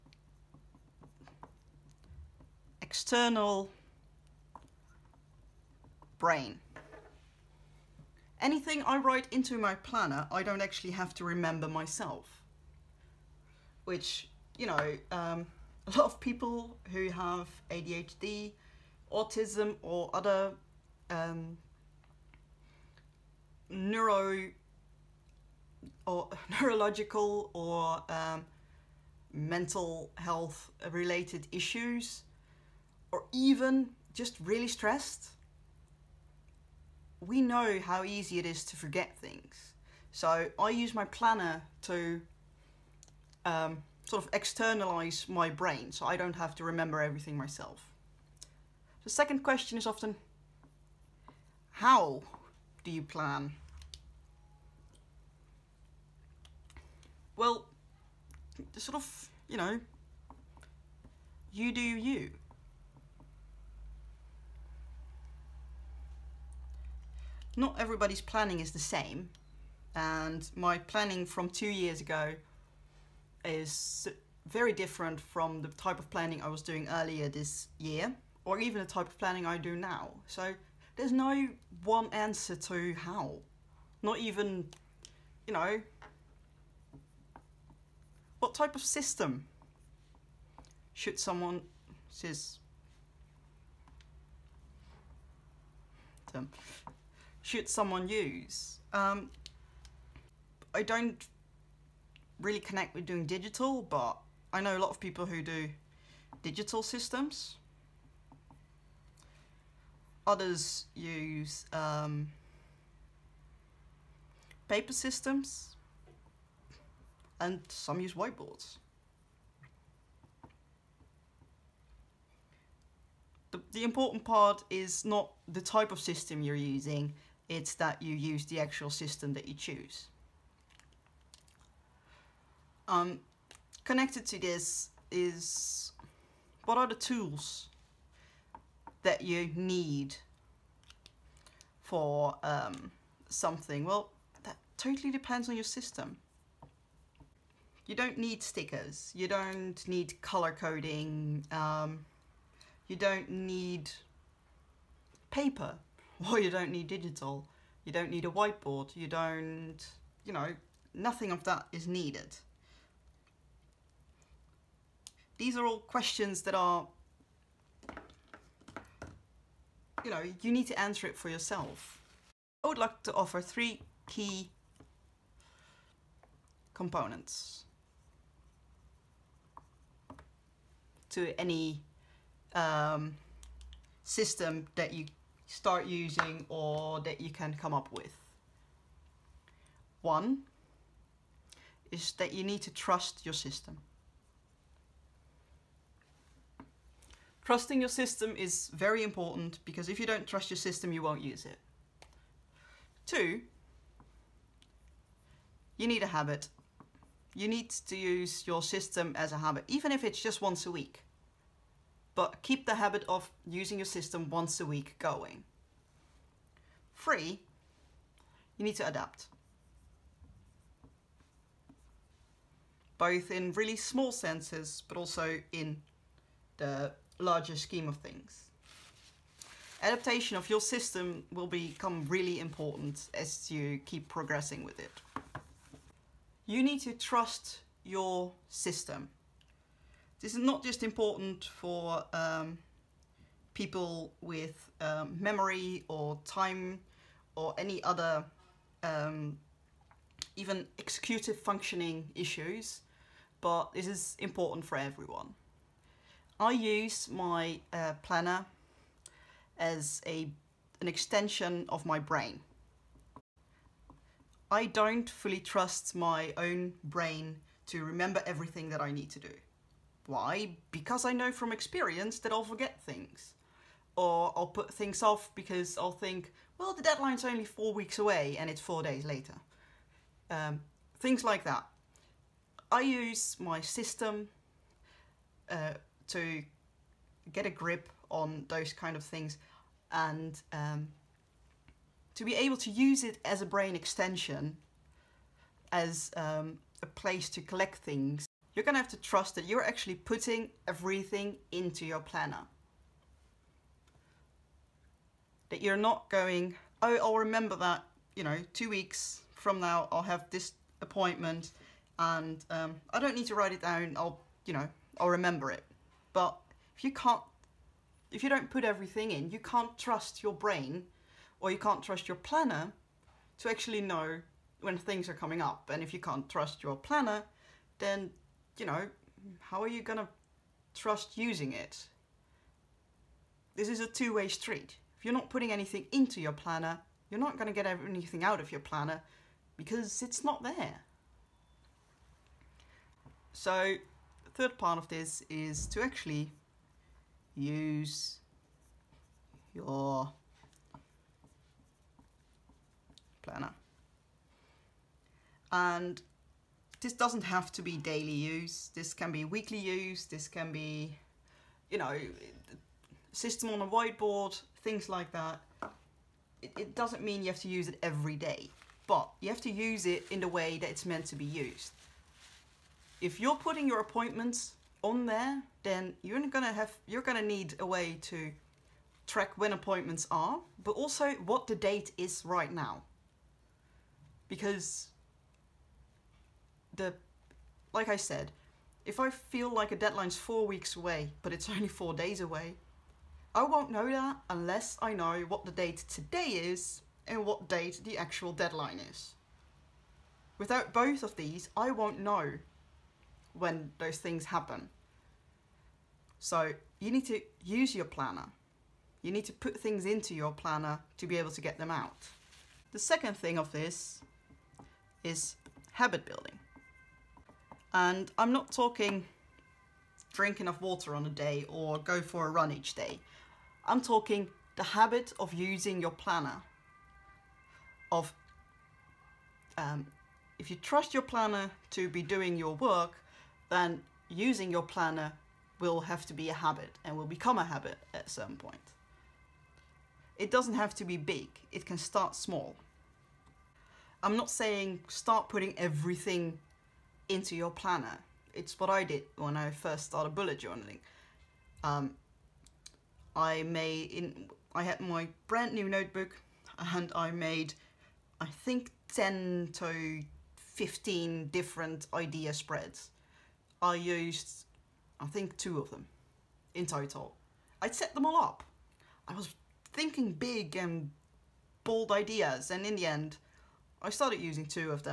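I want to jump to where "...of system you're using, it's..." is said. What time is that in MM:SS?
02:05.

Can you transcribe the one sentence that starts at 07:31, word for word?
Um, I made in I had my brand new notebook and I made I think 10 to 15 different idea spreads.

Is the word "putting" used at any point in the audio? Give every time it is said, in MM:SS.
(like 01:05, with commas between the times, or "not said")
04:59, 05:35, 06:13, 07:25.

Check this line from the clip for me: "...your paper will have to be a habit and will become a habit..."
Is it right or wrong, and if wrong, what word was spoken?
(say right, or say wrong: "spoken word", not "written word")
wrong: "planner", not "paper".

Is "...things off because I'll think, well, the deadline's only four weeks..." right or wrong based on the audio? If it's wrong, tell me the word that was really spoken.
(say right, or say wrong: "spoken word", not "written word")
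right.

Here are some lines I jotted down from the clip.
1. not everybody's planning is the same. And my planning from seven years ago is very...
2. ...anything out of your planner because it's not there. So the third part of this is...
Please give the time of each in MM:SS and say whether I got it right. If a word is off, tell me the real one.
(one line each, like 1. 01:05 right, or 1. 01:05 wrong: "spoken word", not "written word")
1. 01:07 wrong: "two", not "seven"
2. 05:37 right.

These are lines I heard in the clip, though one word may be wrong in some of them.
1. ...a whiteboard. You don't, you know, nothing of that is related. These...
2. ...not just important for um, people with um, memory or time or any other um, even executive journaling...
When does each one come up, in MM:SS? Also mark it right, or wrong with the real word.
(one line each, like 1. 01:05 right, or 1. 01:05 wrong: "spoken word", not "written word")
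1. 02:38 wrong: "needed", not "related"
2. 04:00 wrong: "functioning", not "journaling".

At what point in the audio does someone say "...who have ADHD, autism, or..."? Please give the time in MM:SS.
00:16.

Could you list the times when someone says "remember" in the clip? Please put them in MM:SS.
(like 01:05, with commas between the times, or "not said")
00:11, 00:46, 04:27, 05:07, 05:15.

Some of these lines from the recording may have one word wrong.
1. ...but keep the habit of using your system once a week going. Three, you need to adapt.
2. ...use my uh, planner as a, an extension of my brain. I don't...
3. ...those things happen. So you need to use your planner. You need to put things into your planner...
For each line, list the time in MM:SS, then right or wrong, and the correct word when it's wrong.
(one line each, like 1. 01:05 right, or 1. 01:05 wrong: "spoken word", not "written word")
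1. 03:32 right
2. 04:16 right
3. 06:43 right.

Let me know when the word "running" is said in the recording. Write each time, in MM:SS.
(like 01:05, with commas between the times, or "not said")
not said.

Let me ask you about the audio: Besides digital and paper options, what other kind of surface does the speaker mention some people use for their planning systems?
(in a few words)
whiteboards.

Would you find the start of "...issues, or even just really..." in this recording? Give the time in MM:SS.
00:31.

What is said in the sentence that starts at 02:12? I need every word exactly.
Um, connected to this is what are the tools that you need for um, something?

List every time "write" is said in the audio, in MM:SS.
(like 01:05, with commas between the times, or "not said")
00:09, 05:13.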